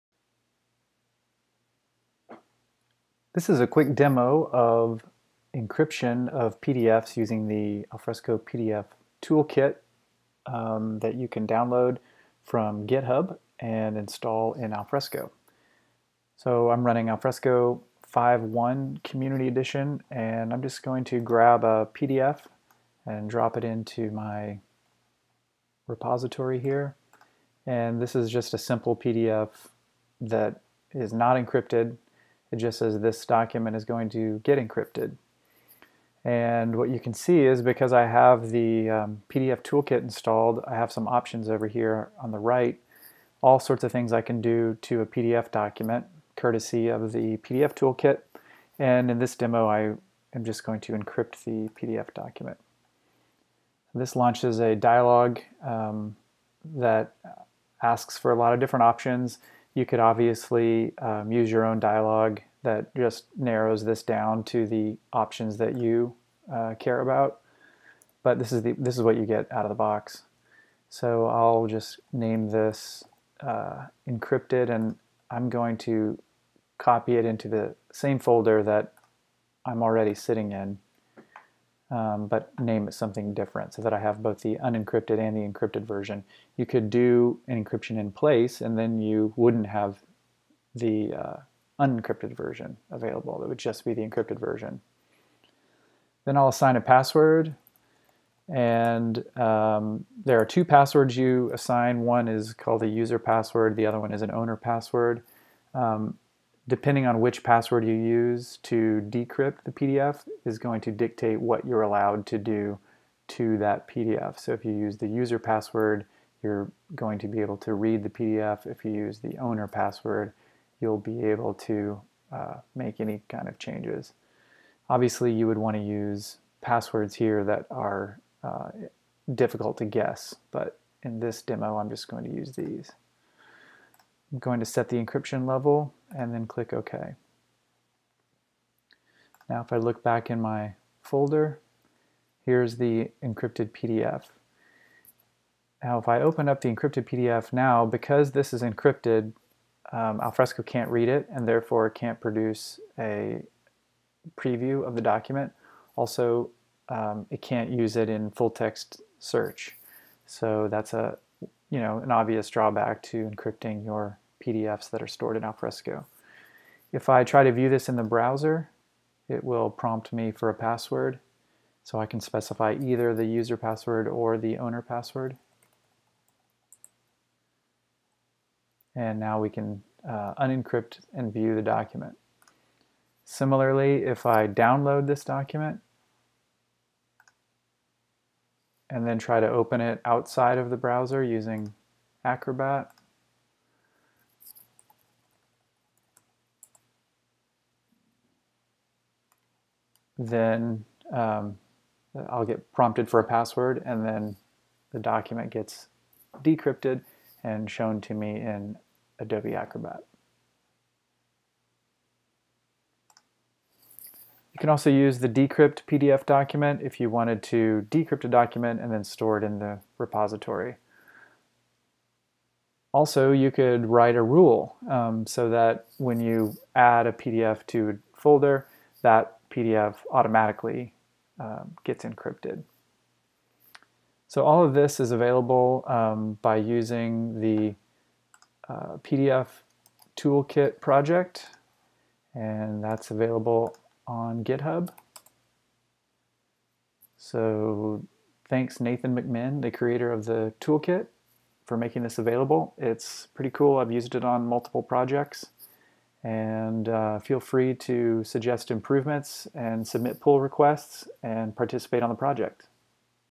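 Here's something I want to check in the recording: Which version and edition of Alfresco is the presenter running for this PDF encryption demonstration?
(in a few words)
5.1 Community Edition.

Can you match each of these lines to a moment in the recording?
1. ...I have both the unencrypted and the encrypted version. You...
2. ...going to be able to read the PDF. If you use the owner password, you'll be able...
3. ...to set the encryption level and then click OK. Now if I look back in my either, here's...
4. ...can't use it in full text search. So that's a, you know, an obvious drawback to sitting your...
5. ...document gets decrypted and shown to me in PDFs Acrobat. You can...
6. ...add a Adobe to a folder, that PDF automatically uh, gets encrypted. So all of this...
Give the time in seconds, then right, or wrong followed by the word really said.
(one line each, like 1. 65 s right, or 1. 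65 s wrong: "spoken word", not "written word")
1. 83 s right
2. 116 s right
3. 134 s wrong: "folder", not "either"
4. 157 s wrong: "encrypting", not "sitting"
5. 204 s wrong: "Adobe", not "PDFs"
6. 226 s wrong: "PDF", not "Adobe".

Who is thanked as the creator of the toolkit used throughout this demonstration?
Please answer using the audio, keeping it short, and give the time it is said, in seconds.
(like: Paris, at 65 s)
Nathan McMinn, at 248 s.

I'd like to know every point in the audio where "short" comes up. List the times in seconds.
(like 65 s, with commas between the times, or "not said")
not said.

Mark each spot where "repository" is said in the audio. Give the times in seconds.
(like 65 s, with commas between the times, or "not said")
25 s, 219 s.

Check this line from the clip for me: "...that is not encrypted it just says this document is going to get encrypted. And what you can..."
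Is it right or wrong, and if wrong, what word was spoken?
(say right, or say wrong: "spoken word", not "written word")
right.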